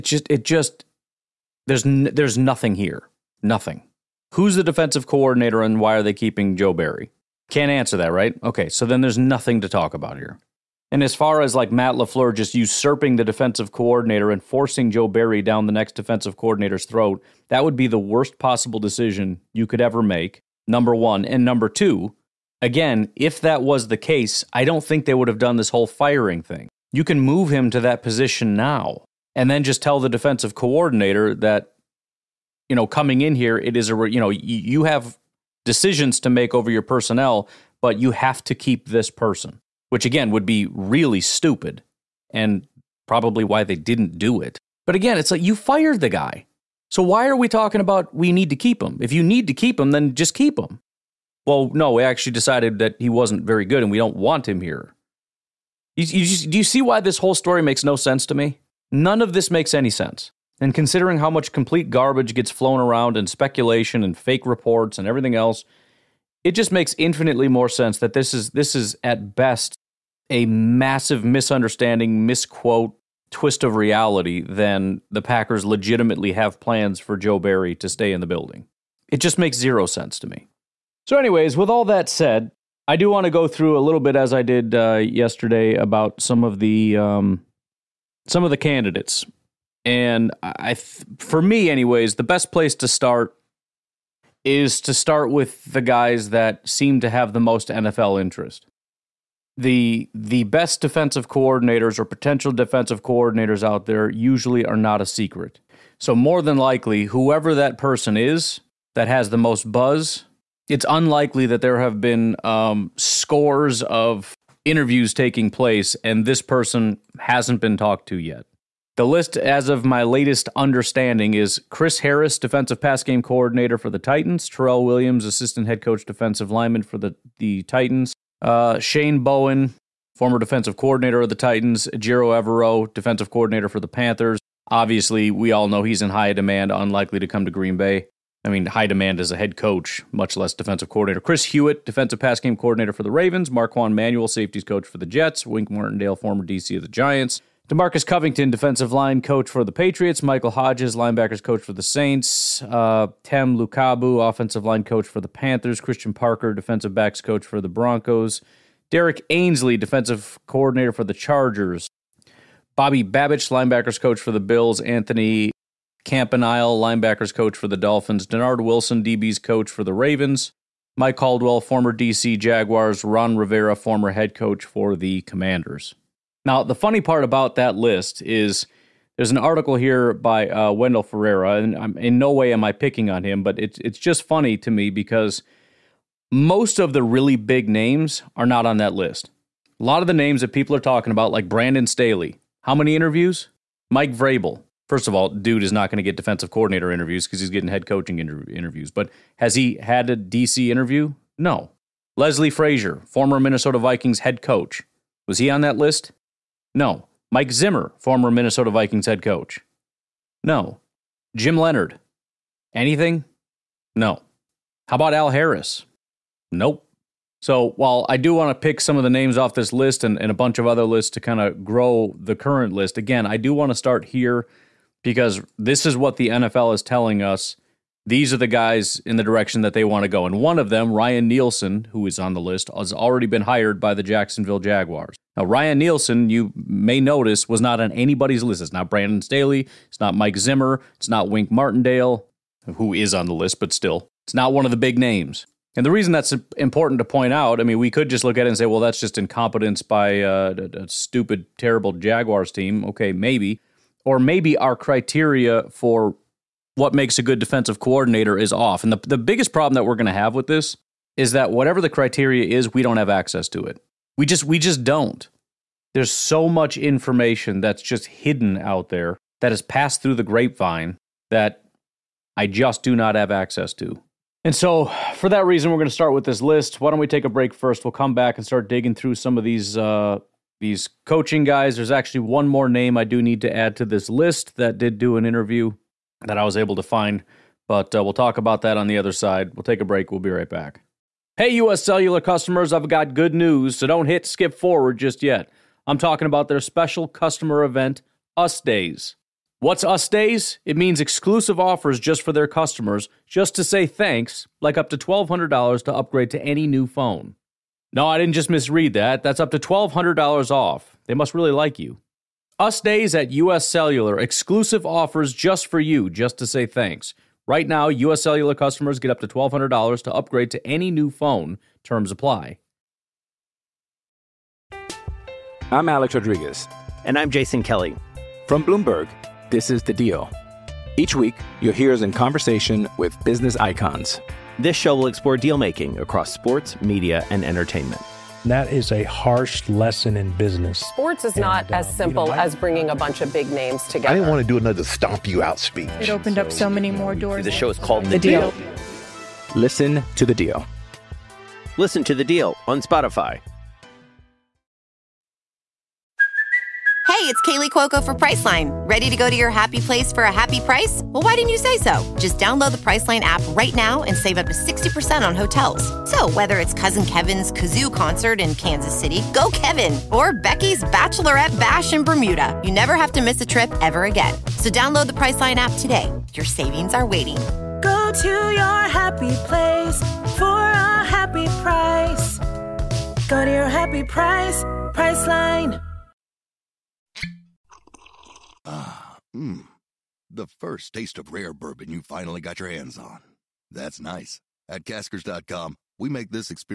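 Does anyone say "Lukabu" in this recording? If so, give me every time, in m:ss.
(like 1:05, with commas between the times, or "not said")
2:33.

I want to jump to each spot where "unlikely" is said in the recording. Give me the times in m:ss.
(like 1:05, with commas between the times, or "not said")
1:50, 2:16.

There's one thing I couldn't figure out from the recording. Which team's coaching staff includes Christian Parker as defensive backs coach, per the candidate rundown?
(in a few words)
Broncos.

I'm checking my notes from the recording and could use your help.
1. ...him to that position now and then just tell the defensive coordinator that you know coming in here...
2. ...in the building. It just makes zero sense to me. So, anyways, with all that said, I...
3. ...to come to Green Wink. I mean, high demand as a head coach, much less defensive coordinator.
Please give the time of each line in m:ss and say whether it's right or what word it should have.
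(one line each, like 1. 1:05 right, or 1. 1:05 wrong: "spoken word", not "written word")
1. 0:27 right
2. 1:18 right
3. 2:17 wrong: "Bay", not "Wink".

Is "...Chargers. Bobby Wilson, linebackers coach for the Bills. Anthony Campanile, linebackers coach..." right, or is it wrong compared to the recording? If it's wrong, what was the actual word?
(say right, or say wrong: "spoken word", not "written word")
wrong: "Babich", not "Wilson".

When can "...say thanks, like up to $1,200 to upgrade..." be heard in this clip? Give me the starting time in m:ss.
5:03.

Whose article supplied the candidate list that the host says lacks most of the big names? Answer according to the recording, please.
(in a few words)
Wendell Ferreira.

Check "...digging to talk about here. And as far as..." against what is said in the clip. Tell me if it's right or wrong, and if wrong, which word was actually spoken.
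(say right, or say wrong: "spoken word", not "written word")
wrong: "nothing", not "digging".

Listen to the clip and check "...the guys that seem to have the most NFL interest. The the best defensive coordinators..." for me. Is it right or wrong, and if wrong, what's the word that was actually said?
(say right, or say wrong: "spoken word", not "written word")
right.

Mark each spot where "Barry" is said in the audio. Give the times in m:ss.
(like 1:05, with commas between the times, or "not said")
0:06, 0:15, 1:17.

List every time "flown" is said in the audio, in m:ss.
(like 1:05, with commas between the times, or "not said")
1:02.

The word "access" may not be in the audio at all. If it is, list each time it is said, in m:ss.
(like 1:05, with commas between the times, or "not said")
4:23, 4:33.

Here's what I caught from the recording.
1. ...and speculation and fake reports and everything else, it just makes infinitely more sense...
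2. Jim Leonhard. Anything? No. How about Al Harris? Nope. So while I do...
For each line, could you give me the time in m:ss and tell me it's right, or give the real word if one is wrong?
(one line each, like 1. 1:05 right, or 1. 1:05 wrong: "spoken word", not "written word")
1. 1:03 right
2. 3:31 right.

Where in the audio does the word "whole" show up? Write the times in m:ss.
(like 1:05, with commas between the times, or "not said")
0:25, 0:57.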